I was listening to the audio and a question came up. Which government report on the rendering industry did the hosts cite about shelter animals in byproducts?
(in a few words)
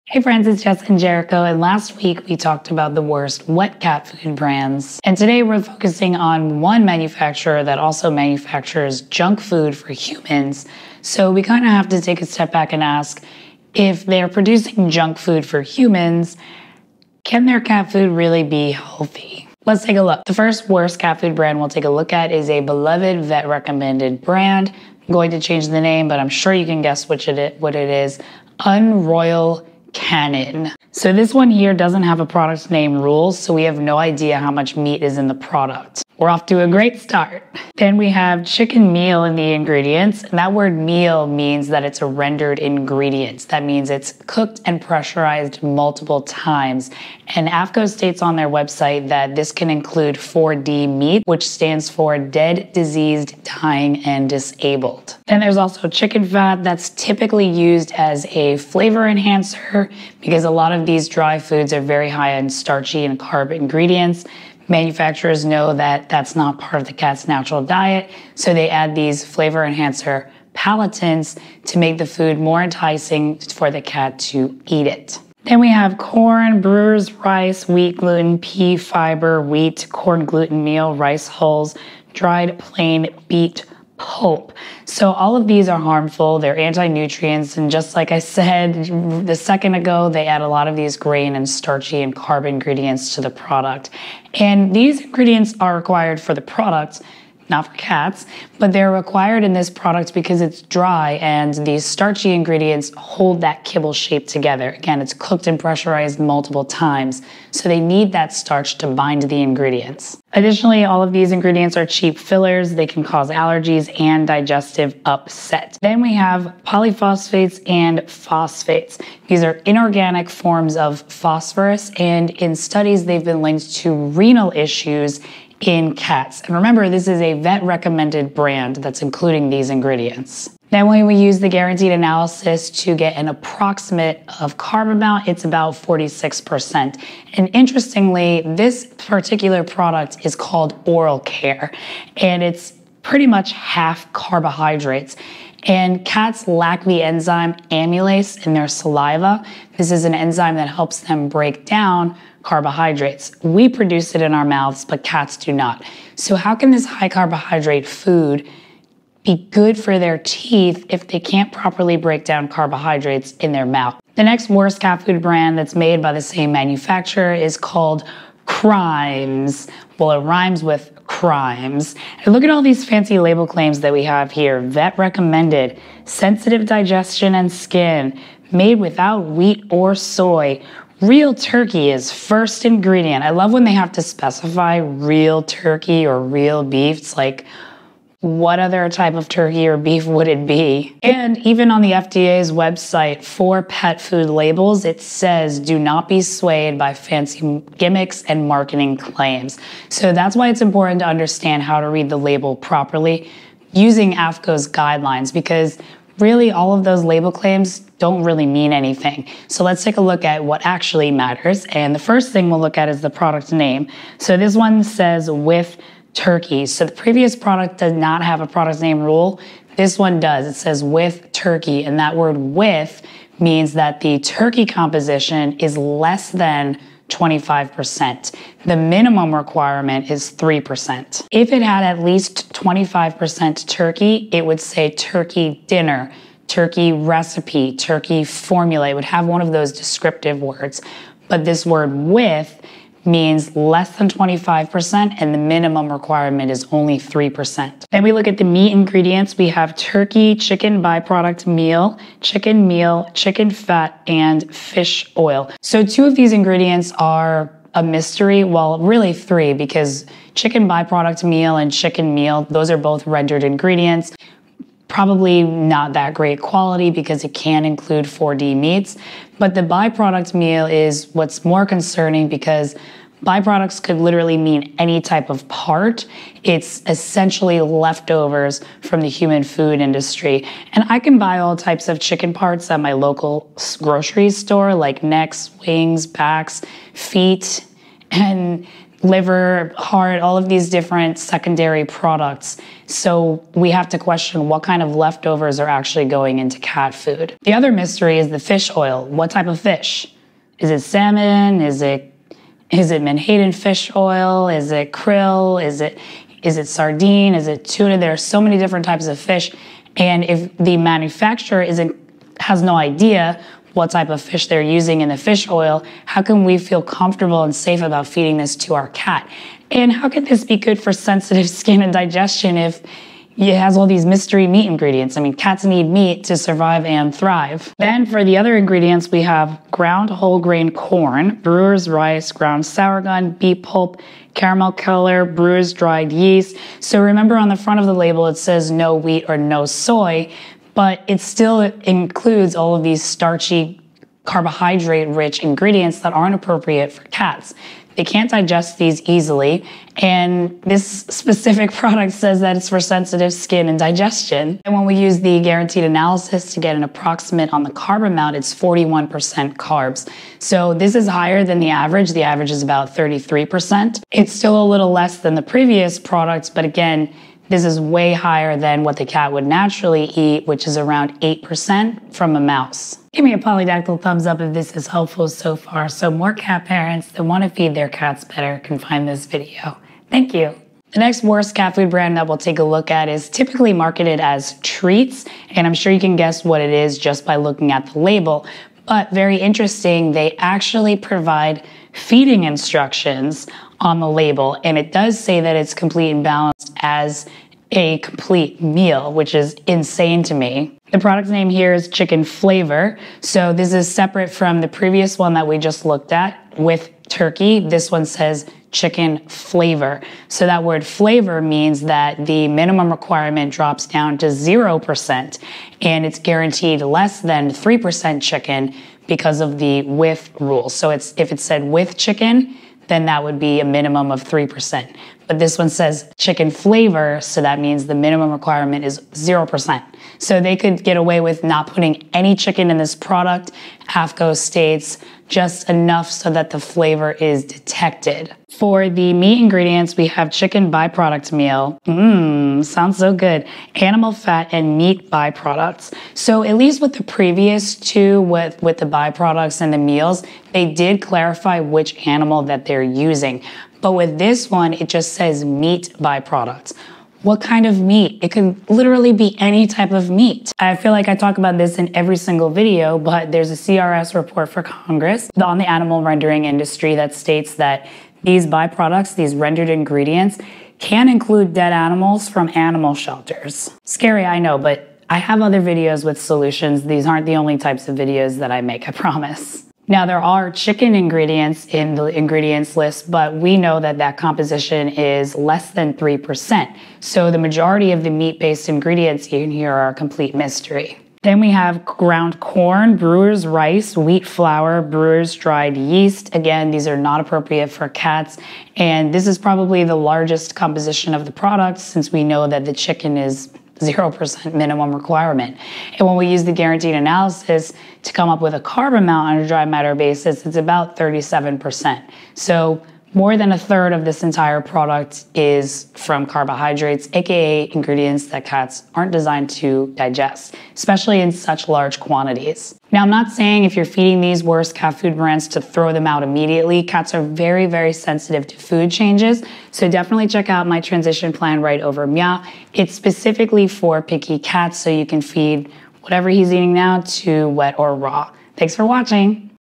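CRS report.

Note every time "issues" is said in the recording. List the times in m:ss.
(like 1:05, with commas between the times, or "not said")
2:04.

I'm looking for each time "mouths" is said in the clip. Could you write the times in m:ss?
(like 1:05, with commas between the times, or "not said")
2:34, 2:43.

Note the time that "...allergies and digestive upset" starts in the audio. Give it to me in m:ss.
1:53.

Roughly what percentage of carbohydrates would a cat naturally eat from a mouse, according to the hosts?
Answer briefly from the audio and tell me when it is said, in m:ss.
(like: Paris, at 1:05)
8%, at 6:11.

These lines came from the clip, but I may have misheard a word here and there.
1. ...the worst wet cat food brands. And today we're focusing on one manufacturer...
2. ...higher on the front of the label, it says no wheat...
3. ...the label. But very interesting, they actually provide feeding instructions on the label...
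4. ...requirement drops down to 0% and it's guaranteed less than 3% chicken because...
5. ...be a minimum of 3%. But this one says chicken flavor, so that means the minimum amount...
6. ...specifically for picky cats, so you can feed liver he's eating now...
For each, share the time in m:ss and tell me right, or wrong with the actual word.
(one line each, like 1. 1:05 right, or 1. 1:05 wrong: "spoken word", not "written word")
1. 0:02 right
2. 5:37 wrong: "remember", not "higher"
3. 6:27 right
4. 6:52 right
5. 7:03 wrong: "requirement", not "amount"
6. 8:52 wrong: "whatever", not "liver".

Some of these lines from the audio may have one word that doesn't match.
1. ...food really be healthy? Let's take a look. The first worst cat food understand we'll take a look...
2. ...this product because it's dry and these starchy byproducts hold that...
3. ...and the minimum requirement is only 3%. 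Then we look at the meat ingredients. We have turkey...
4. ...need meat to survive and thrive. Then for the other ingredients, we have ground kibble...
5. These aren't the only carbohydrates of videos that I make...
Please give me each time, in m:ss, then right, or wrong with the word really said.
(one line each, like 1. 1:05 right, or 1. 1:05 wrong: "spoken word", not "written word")
1. 0:17 wrong: "brand", not "understand"
2. 1:39 wrong: "ingredients", not "byproducts"
3. 4:05 right
4. 5:25 wrong: "whole", not "kibble"
5. 7:56 wrong: "types", not "carbohydrates".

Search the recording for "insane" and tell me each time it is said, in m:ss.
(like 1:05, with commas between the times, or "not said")
6:39.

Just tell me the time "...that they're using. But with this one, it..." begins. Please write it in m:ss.
7:32.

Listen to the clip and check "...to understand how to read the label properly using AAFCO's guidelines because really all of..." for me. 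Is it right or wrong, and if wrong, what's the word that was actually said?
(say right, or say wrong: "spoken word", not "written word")
right.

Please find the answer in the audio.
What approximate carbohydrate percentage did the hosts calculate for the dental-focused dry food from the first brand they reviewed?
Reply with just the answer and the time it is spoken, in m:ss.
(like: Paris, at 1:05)
46%, at 2:15.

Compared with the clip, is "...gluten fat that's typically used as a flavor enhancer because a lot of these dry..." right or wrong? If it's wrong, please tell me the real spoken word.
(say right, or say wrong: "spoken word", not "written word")
wrong: "chicken", not "gluten".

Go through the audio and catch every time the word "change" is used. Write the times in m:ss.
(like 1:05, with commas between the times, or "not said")
0:25, 8:48.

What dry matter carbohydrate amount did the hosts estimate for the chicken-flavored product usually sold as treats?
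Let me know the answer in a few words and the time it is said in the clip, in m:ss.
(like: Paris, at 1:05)
37%, at 8:30.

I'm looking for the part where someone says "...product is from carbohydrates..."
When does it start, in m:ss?
8:34.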